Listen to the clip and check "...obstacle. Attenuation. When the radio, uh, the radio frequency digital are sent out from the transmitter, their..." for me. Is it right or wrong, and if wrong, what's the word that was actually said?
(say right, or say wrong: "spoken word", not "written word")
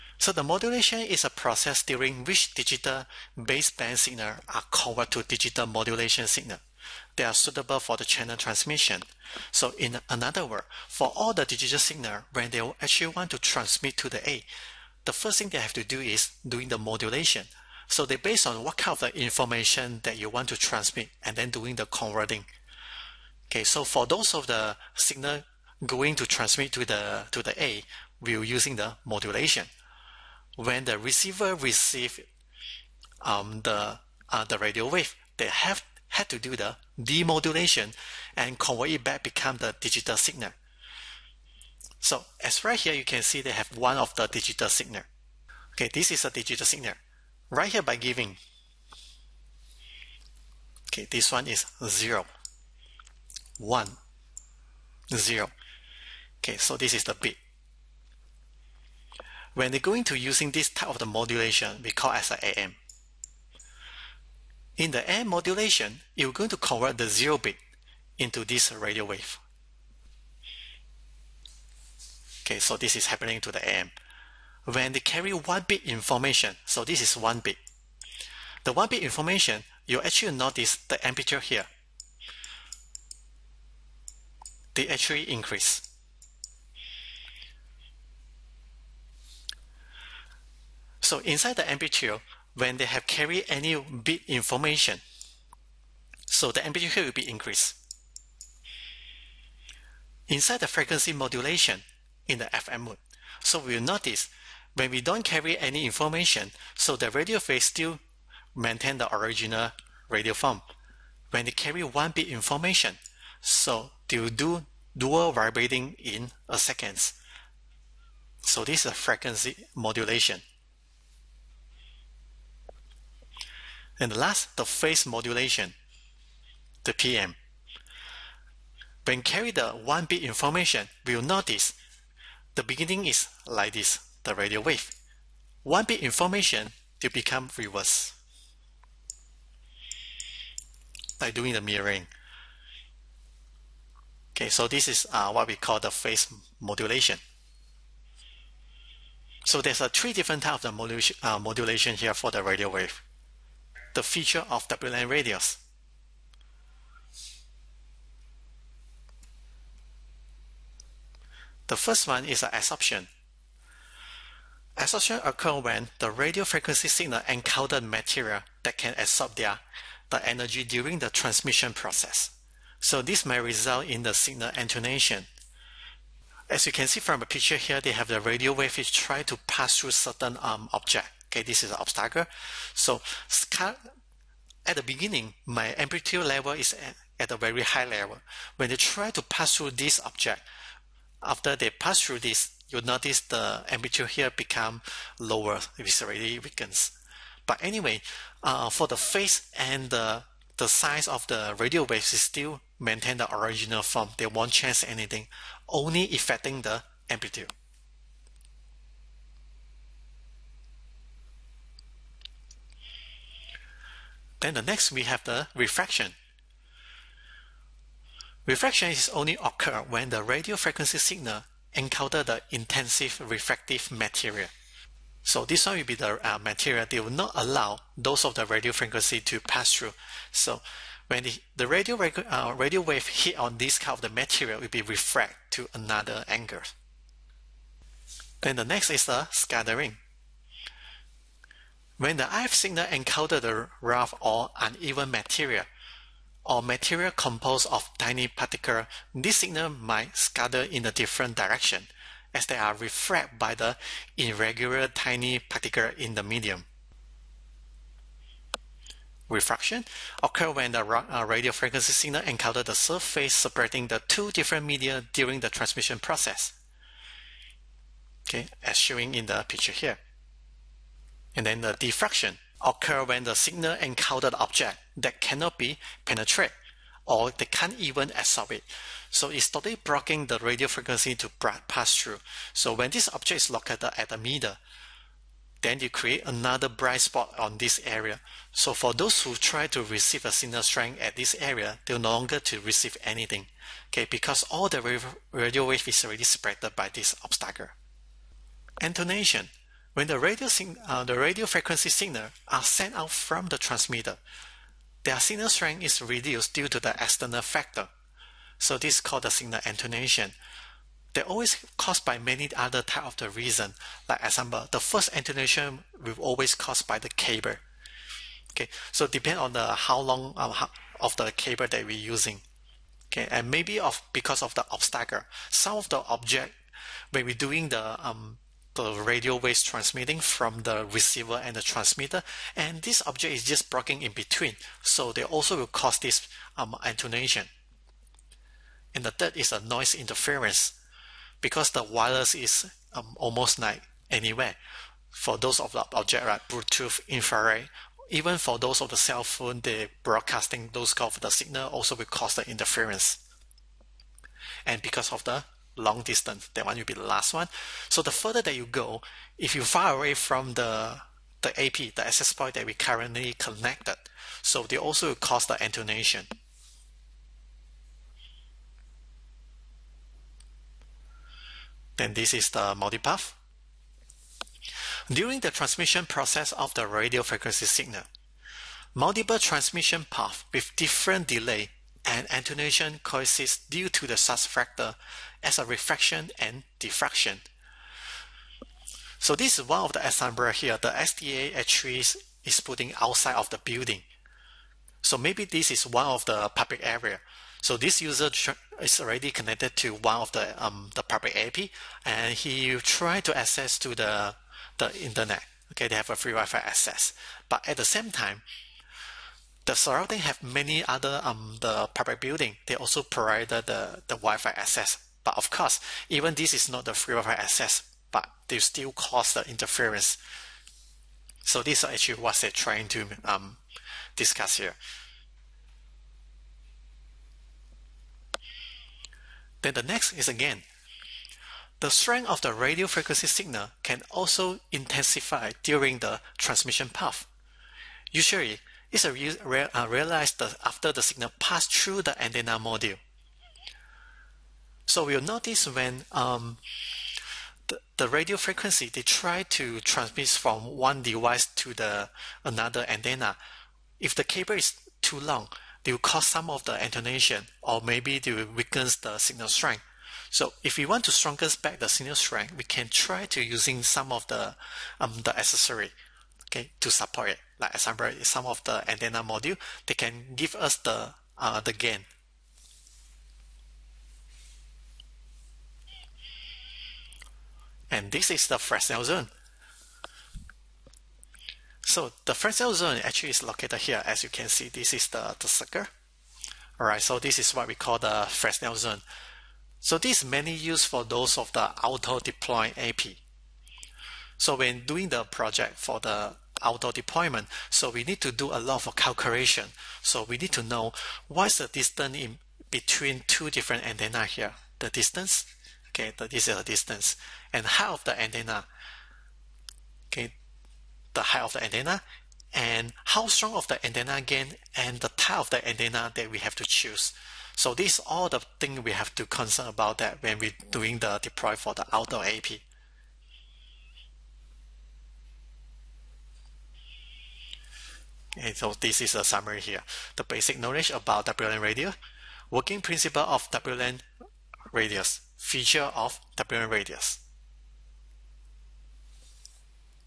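wrong: "signal", not "digital".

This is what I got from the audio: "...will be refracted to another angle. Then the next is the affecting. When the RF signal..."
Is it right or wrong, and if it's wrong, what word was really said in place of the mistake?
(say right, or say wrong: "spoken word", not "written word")
wrong: "scattering", not "affecting".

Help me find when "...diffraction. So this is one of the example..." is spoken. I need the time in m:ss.
6:26.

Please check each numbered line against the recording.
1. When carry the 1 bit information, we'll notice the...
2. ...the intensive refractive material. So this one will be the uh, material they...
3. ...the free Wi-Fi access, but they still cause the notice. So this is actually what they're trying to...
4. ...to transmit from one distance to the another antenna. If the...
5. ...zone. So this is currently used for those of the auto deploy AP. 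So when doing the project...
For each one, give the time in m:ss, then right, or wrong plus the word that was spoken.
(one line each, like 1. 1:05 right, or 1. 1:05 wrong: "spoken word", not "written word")
1. 2:09 right
2. 3:42 right
3. 6:56 wrong: "interference", not "notice"
4. 7:29 wrong: "device", not "distance"
5. 8:08 wrong: "mainly", not "currently".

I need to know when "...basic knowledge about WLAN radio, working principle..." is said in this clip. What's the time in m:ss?
8:50.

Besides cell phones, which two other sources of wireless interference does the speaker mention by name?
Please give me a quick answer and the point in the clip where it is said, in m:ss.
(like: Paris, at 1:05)
Bluetooth, infrared, at 5:46.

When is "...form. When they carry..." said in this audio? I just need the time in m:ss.
1:50.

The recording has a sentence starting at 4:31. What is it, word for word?
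And then the diffraction occurs when the signal encounters the object that cannot be penetrated or they can't even absorb it.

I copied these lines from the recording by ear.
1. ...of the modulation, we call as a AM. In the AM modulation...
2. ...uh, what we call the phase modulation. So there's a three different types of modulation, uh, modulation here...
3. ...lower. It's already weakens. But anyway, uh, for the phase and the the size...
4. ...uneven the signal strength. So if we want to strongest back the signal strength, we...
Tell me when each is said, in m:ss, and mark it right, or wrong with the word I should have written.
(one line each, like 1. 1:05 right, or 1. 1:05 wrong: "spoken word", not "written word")
1. 1:00 right
2. 2:25 right
3. 3:15 right
4. 7:38 wrong: "weaken", not "uneven".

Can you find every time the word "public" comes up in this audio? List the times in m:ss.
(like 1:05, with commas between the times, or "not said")
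6:36, 6:41, 6:51.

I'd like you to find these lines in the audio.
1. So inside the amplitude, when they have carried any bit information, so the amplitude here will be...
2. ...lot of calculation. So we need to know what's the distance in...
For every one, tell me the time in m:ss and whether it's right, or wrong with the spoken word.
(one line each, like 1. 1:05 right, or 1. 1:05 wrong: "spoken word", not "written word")
1. 1:31 right
2. 8:18 right.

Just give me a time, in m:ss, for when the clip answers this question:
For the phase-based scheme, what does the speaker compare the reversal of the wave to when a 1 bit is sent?
2:21.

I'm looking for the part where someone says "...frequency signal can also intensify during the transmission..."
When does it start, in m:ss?
7:12.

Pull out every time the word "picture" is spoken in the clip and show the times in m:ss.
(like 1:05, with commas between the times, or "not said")
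2:57, 4:29.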